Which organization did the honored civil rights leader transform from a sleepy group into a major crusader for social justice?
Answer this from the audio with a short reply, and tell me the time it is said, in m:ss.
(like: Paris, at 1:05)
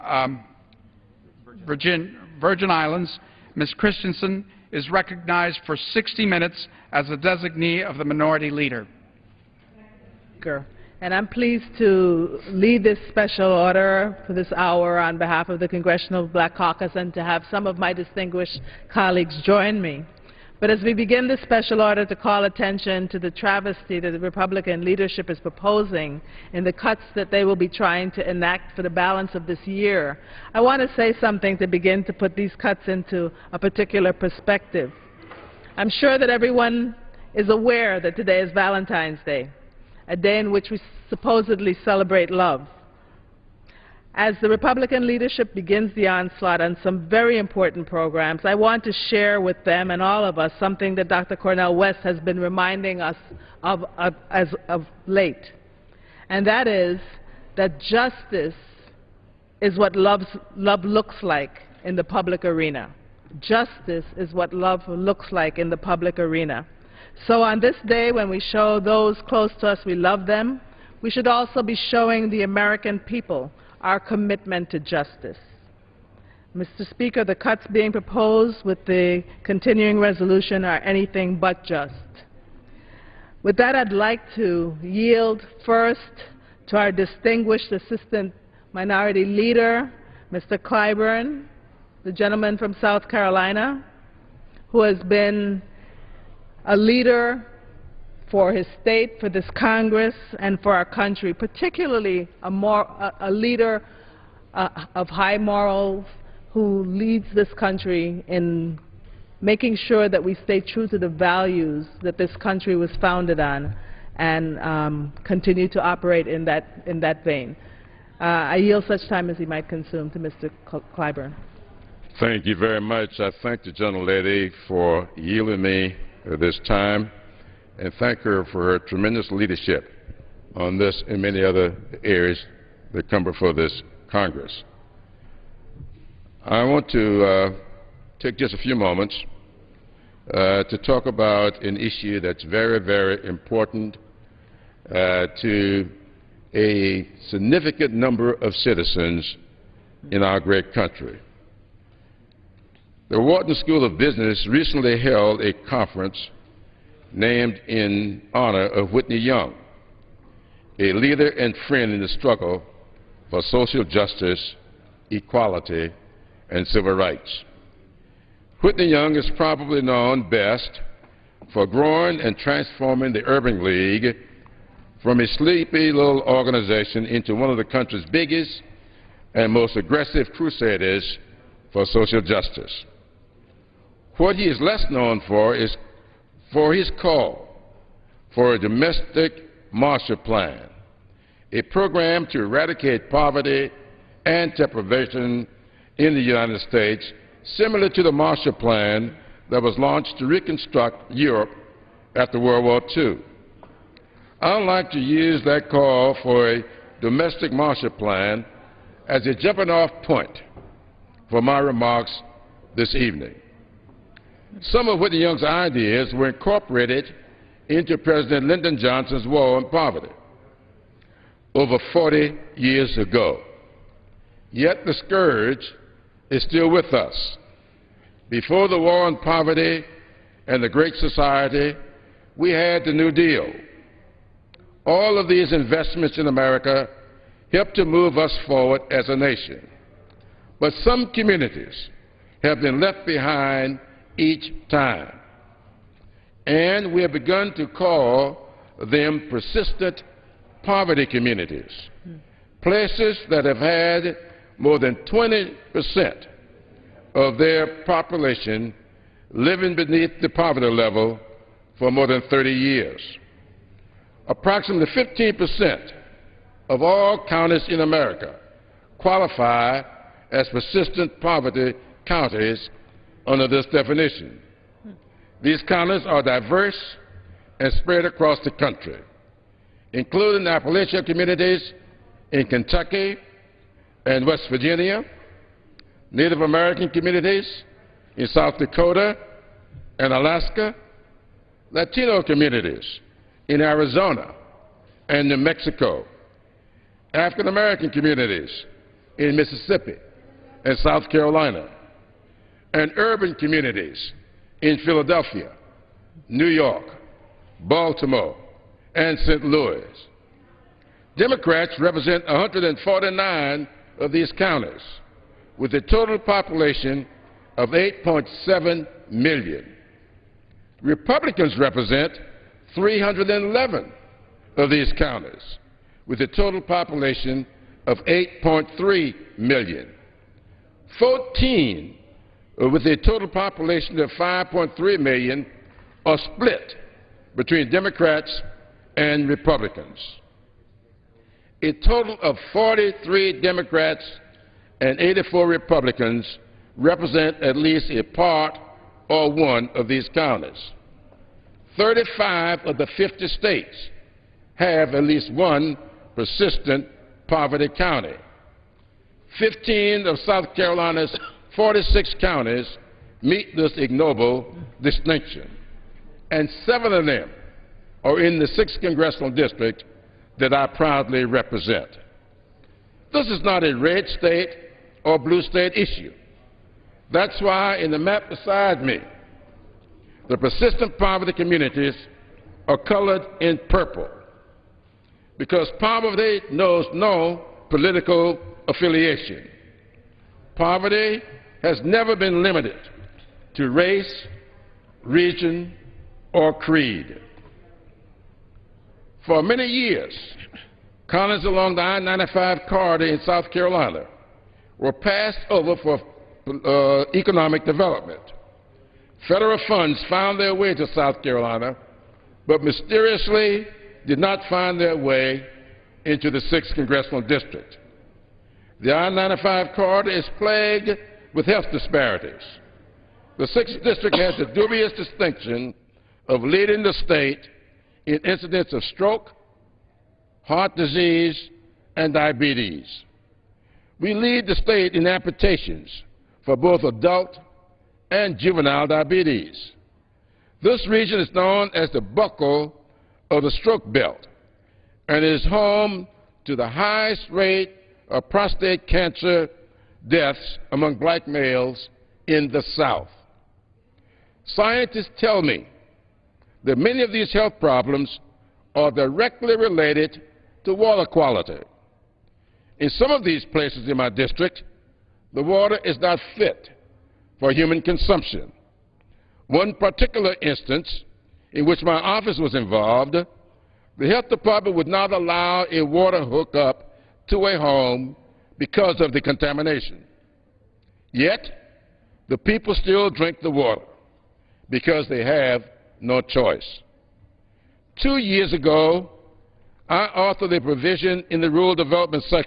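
Urban League, at 2:53.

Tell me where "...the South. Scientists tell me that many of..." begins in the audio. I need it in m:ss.
7:32.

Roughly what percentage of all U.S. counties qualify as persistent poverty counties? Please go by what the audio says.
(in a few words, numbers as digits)
15 percent.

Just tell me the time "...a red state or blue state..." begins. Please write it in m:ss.
6:13.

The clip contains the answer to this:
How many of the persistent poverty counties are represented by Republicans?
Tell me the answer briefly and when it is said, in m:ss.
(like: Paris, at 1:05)
311, at 5:22.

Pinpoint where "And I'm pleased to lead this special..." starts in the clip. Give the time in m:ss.
0:11.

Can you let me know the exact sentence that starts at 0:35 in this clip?
I'm sure that everyone is aware that today is Valentine's Day, a day in which we supposedly celebrate love.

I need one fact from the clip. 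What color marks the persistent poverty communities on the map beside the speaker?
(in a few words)
Purple.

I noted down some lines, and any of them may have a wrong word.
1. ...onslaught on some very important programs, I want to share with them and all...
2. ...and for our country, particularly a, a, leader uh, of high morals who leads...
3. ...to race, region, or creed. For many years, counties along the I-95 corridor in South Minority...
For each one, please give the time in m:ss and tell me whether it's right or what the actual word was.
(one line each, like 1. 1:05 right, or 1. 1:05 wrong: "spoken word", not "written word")
1. 0:46 right
2. 1:40 right
3. 6:33 wrong: "Carolina", not "Minority".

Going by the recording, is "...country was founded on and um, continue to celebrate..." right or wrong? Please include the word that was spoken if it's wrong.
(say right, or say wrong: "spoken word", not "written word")
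wrong: "operate", not "celebrate".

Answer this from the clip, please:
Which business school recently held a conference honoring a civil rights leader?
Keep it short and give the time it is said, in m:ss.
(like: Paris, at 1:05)
Wharton School of Business, at 2:33.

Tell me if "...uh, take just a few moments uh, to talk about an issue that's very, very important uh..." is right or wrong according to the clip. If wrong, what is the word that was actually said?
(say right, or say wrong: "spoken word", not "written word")
right.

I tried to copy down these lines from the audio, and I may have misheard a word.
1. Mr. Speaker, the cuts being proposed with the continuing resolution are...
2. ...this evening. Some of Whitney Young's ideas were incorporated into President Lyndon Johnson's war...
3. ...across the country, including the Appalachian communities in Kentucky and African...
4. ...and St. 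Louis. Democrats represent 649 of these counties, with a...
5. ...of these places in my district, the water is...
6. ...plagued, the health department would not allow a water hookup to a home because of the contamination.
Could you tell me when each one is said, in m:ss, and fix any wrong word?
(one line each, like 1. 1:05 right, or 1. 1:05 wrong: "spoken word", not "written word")
1. 1:16 right
2. 3:32 right
3. 4:38 wrong: "West", not "African"
4. 5:08 wrong: "149", not "649"
5. 7:43 right
6. 7:52 wrong: "involved", not "plagued".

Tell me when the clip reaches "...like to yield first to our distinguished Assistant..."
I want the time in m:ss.
1:23.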